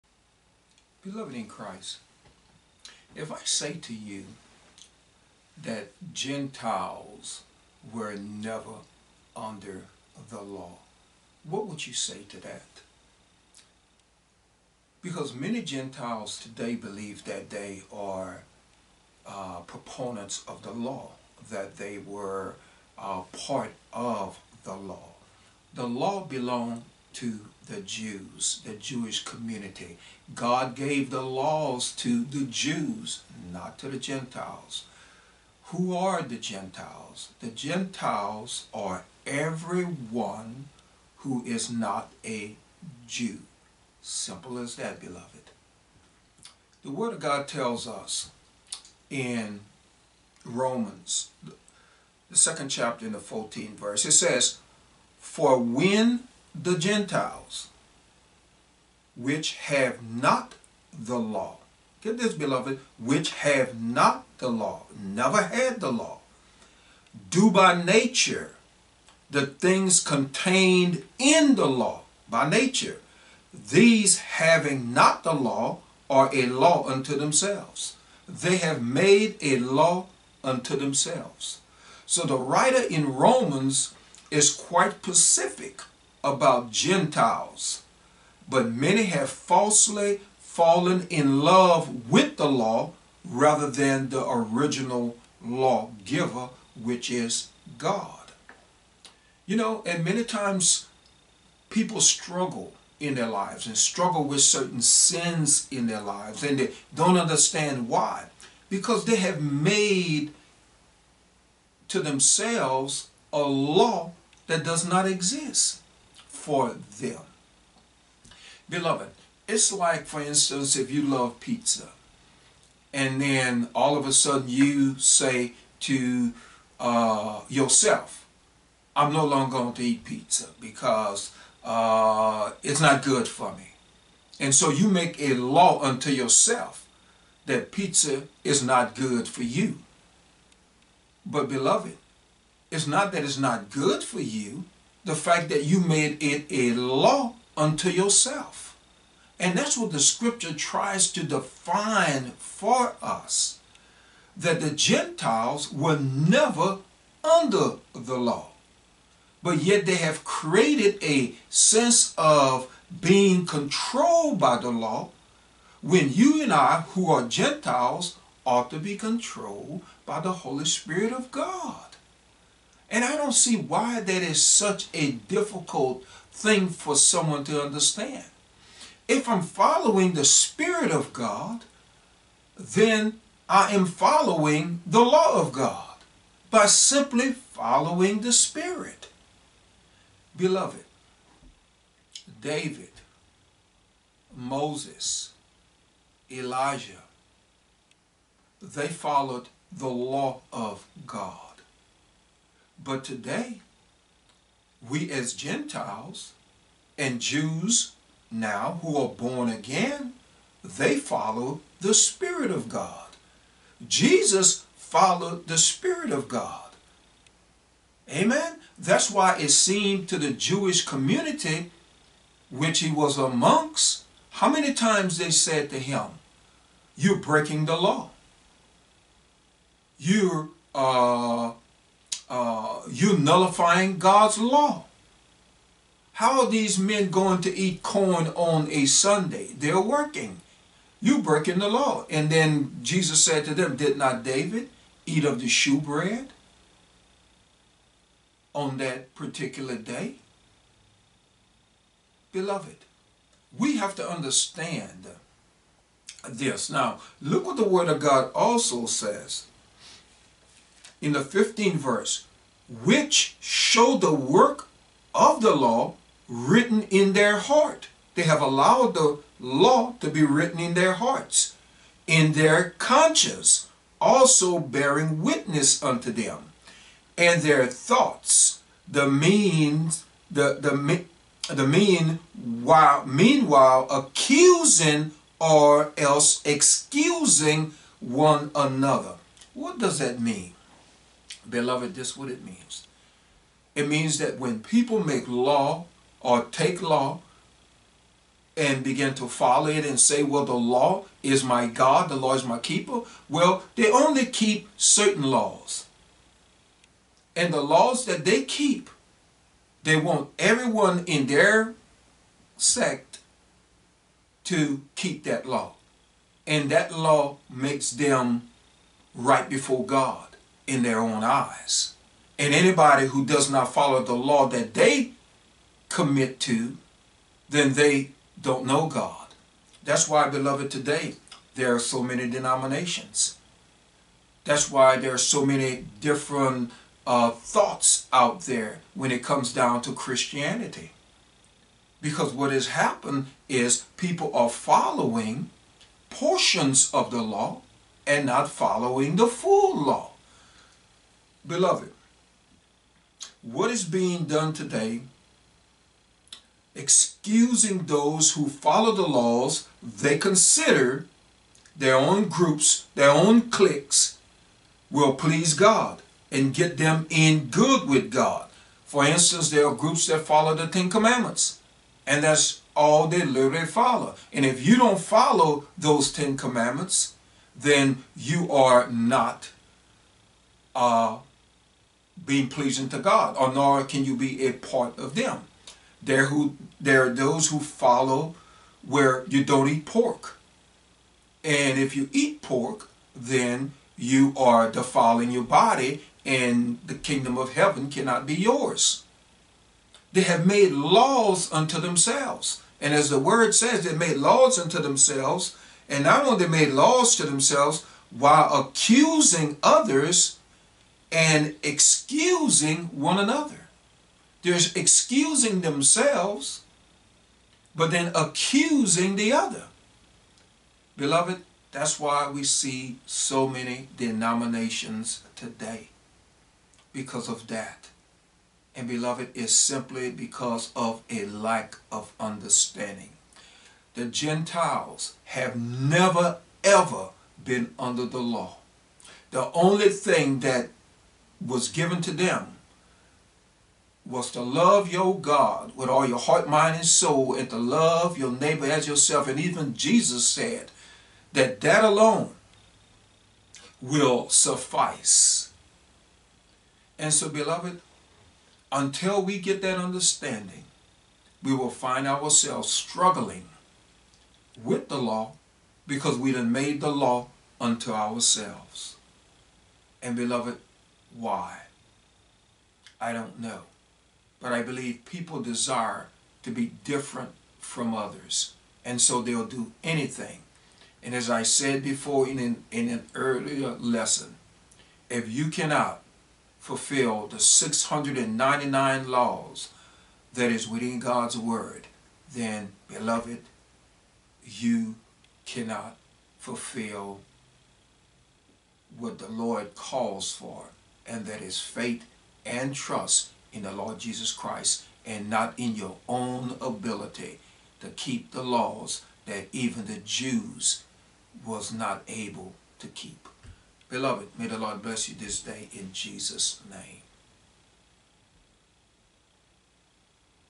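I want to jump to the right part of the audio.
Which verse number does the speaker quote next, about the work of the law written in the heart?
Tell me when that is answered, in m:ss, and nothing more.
4:21.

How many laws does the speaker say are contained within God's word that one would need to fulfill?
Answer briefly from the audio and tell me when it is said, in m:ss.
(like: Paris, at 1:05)
699, at 8:07.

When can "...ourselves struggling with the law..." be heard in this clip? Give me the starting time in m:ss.
7:42.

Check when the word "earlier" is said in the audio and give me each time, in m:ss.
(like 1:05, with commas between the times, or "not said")
8:03.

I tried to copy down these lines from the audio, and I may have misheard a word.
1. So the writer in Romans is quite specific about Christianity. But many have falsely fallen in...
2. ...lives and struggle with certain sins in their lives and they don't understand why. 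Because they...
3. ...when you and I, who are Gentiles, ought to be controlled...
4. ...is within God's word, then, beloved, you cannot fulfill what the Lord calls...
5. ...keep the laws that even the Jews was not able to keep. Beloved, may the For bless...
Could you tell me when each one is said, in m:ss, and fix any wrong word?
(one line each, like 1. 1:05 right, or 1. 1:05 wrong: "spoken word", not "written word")
1. 1:22 wrong: "Gentiles", not "Christianity"
2. 1:43 right
3. 2:45 right
4. 8:10 right
5. 8:27 wrong: "Lord", not "For".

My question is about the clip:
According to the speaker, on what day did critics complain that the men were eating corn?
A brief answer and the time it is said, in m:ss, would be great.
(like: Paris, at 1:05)
Sunday, at 3:58.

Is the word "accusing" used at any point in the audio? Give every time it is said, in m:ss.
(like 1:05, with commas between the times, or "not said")
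4:43, 6:48, 6:58.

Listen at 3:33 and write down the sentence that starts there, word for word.
Jesus followed the Spirit of God.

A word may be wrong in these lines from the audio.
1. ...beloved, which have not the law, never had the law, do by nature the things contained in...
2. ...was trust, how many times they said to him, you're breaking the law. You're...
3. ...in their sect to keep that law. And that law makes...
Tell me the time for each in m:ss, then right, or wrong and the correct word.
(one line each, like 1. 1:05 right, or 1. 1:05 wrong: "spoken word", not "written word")
1. 1:02 right
2. 3:42 wrong: "amongst", not "trust"
3. 5:11 right.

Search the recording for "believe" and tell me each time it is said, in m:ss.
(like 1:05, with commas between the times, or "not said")
0:16, 7:54.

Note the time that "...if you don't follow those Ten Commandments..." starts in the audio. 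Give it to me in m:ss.
6:14.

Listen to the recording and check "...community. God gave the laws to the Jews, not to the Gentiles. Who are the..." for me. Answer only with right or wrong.
right.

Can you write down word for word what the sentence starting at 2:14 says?
And so you make a law unto yourself that pizza is not good for you.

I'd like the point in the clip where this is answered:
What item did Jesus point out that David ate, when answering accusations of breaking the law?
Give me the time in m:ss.
4:05.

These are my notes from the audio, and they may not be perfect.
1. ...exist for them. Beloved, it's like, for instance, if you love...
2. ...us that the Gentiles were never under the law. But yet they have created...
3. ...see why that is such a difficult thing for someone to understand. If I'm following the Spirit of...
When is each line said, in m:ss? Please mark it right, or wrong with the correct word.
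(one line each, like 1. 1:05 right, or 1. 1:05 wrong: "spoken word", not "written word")
1. 1:55 right
2. 2:33 right
3. 2:53 right.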